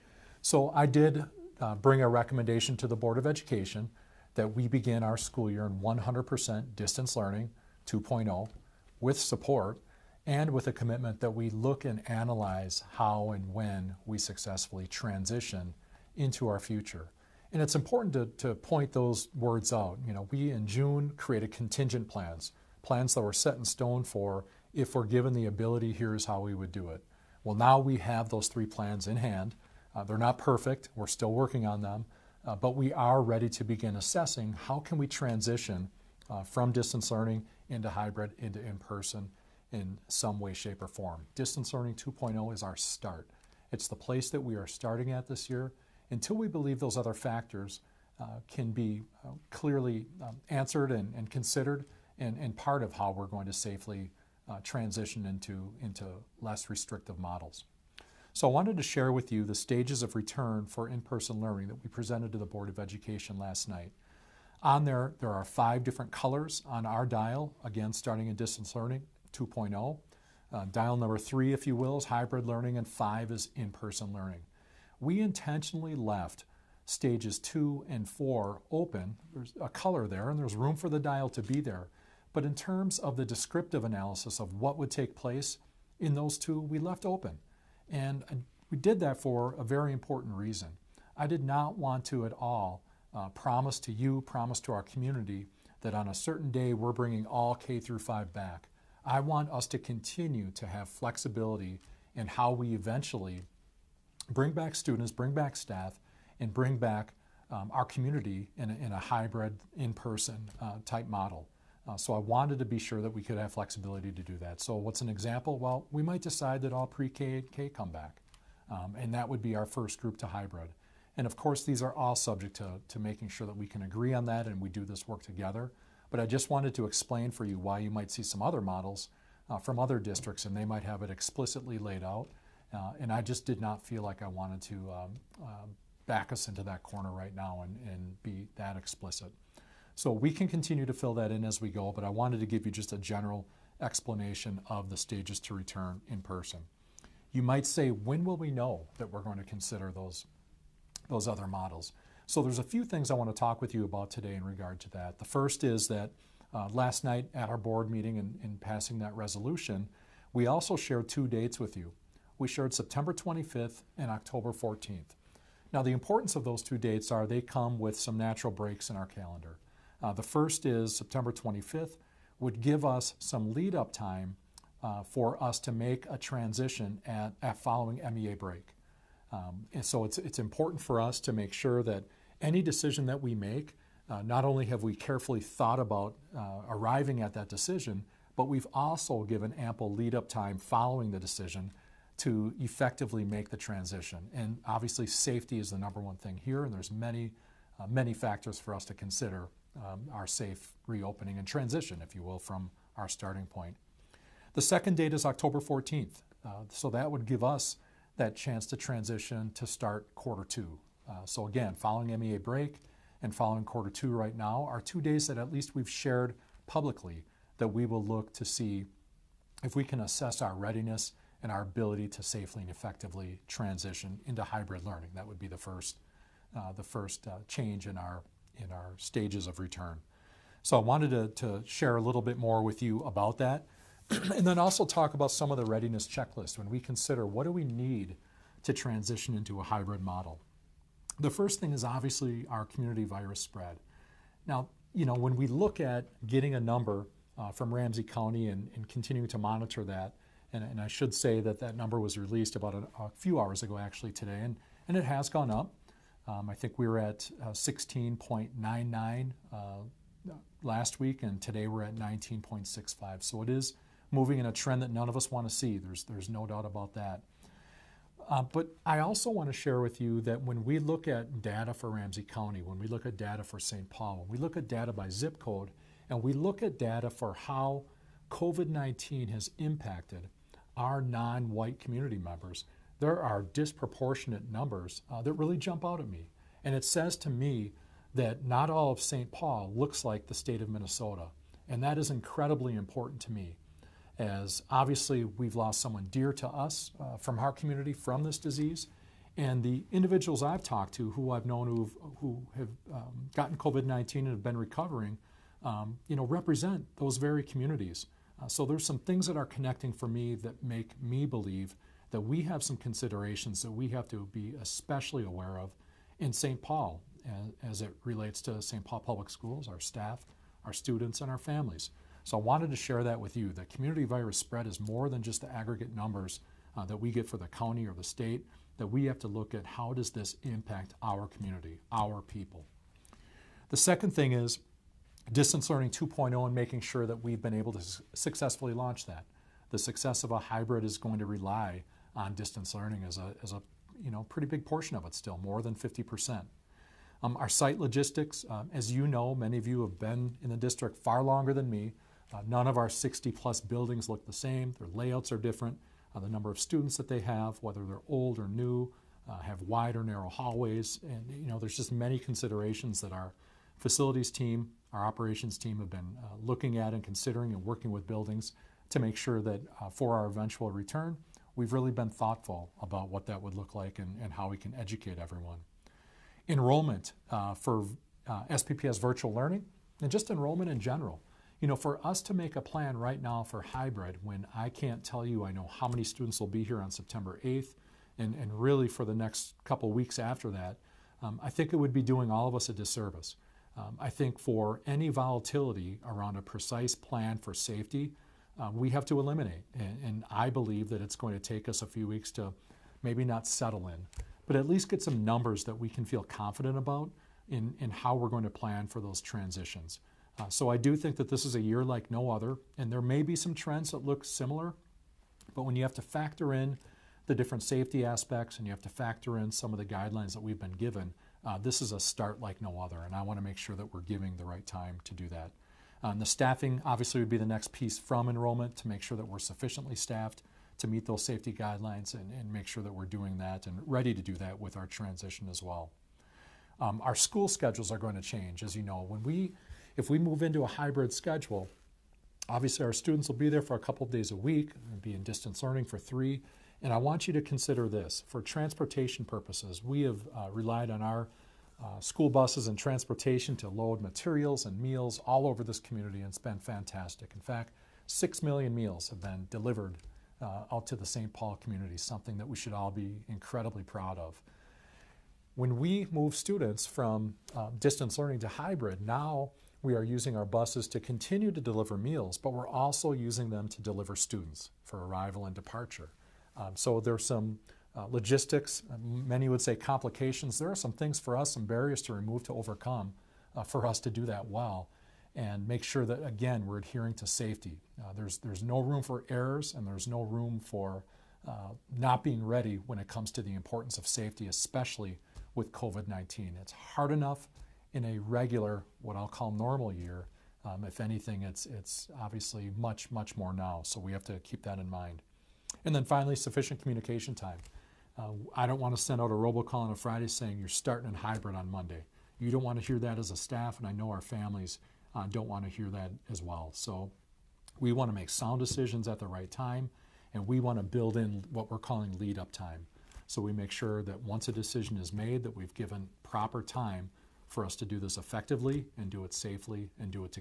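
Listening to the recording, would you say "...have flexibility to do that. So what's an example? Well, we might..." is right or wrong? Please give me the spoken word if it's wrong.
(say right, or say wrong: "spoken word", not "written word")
right.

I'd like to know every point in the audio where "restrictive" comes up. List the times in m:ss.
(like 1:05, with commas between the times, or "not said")
0:56.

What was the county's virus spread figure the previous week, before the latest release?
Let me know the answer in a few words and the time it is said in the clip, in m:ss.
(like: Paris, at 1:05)
16.99, at 4:17.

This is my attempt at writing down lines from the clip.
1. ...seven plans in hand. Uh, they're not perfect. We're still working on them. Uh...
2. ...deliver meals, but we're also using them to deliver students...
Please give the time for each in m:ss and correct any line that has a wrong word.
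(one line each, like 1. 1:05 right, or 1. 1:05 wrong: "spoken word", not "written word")
1. 0:28 wrong: "three", not "seven"
2. 7:51 right.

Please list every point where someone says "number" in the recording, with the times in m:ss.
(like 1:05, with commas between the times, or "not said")
1:10, 3:15, 4:06, 4:11, 4:44, 5:25, 5:56, 6:45.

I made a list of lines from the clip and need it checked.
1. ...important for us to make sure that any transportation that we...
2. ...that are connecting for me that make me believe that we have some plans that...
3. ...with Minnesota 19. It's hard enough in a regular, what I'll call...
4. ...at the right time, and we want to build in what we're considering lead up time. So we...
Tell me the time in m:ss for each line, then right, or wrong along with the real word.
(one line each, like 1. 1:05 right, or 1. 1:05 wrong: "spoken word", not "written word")
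1. 3:00 wrong: "decision", not "transportation"
2. 5:09 wrong: "considerations", not "plans"
3. 8:15 wrong: "COVID", not "Minnesota"
4. 8:39 wrong: "calling", not "considering".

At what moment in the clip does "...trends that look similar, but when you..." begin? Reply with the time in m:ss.
6:53.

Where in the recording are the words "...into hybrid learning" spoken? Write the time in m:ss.
3:44.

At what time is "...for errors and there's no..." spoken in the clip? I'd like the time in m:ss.
8:09.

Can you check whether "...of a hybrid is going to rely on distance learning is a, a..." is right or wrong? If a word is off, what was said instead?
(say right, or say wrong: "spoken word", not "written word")
right.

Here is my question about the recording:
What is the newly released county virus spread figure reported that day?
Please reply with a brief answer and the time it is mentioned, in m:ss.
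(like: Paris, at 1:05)
19.65, at 4:21.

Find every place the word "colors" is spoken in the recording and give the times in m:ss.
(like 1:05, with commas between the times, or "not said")
1:06, 1:19.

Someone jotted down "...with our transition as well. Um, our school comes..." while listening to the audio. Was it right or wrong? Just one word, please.
wrong.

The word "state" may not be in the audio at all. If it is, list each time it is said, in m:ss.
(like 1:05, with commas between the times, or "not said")
4:50, 5:28.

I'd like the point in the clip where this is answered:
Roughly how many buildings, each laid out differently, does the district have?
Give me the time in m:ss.
5:52.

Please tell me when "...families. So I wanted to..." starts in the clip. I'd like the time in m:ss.
5:21.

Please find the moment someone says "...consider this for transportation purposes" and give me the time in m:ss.
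7:27.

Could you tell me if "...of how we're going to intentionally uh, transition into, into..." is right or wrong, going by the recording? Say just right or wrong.
wrong.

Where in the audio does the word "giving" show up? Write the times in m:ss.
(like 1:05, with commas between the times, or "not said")
7:04.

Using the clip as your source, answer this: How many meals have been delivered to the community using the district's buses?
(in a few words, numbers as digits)
6 million.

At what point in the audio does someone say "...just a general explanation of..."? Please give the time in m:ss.
2:22.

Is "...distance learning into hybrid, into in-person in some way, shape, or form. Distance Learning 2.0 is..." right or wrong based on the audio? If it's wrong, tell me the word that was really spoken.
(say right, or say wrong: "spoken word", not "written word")
right.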